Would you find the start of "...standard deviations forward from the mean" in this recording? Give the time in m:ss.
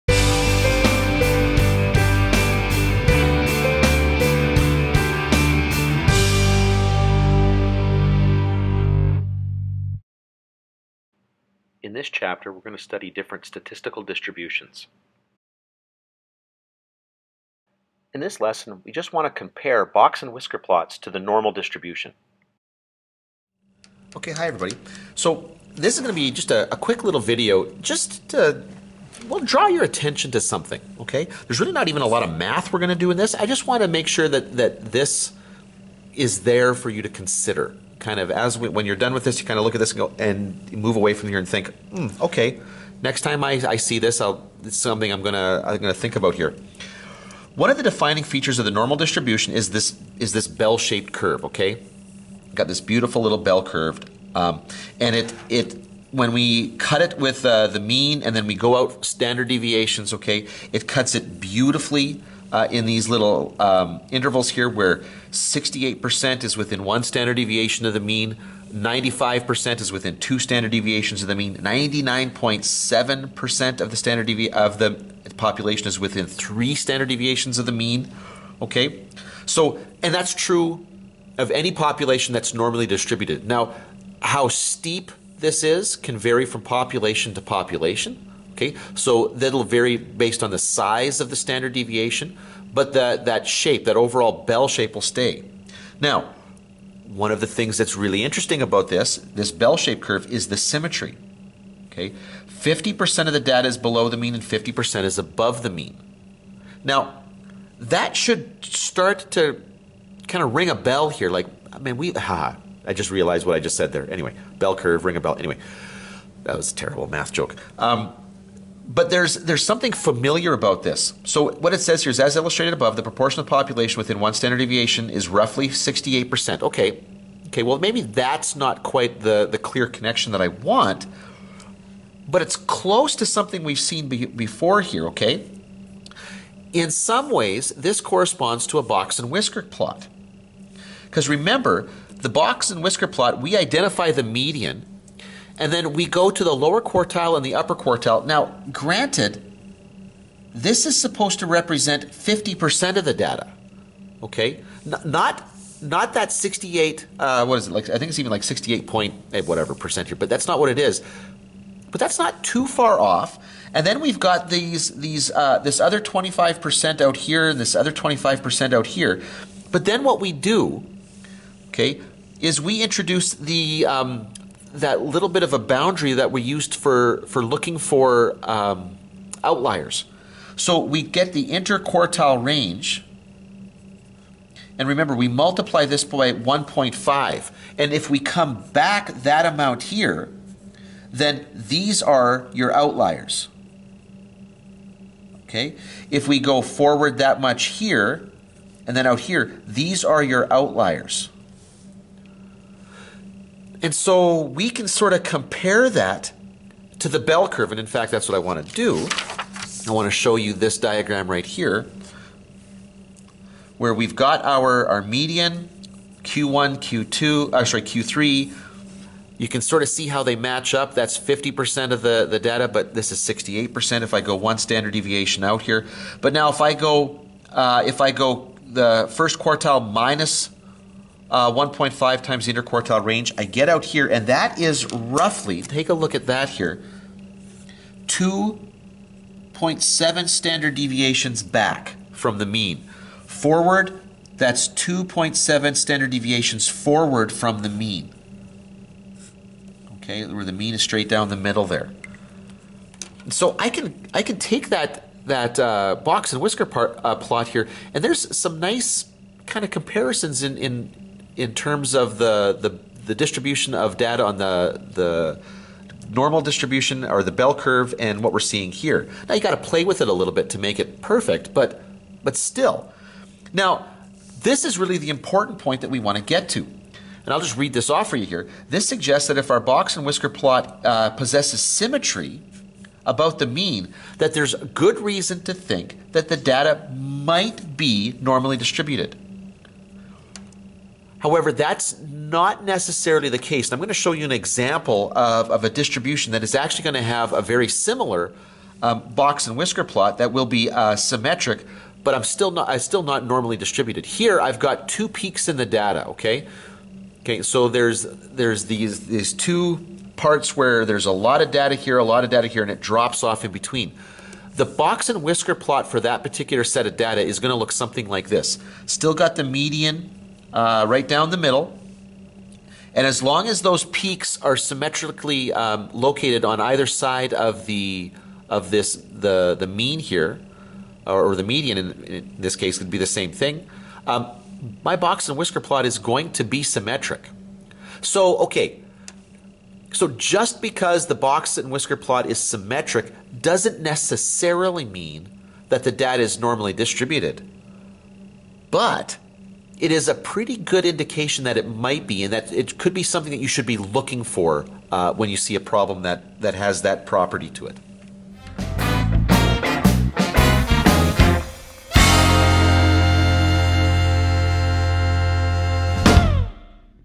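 4:05.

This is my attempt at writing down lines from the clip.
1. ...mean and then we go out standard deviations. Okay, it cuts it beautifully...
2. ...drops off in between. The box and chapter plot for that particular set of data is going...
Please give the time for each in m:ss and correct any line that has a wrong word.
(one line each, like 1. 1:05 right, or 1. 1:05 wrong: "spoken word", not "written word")
1. 0:57 right
2. 5:12 wrong: "whisker", not "chapter".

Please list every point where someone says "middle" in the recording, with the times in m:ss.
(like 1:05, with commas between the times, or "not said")
4:11, 5:21.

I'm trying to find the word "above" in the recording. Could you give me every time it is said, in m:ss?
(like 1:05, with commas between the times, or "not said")
1:45, 2:02.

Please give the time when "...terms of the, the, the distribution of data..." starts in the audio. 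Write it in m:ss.
4:21.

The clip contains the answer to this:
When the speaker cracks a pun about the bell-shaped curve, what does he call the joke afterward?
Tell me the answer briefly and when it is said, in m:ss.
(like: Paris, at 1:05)
terrible math joke, at 1:56.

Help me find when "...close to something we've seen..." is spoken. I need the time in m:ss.
2:12.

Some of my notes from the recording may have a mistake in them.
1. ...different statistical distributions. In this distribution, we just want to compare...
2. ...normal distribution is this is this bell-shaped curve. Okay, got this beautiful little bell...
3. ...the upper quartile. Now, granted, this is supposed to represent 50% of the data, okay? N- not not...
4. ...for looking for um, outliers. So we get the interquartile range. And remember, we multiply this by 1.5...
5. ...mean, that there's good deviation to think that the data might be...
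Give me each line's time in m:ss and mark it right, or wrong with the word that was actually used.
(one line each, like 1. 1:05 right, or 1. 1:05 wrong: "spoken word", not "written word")
1. 0:13 wrong: "lesson", not "distribution"
2. 0:48 right
3. 2:27 right
4. 2:57 right
5. 4:43 wrong: "reason", not "deviation".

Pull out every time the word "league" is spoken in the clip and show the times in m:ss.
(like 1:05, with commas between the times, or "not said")
not said.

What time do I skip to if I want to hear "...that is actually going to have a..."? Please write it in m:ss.
4:56.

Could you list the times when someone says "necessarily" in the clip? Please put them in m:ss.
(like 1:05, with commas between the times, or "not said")
4:52, 5:43.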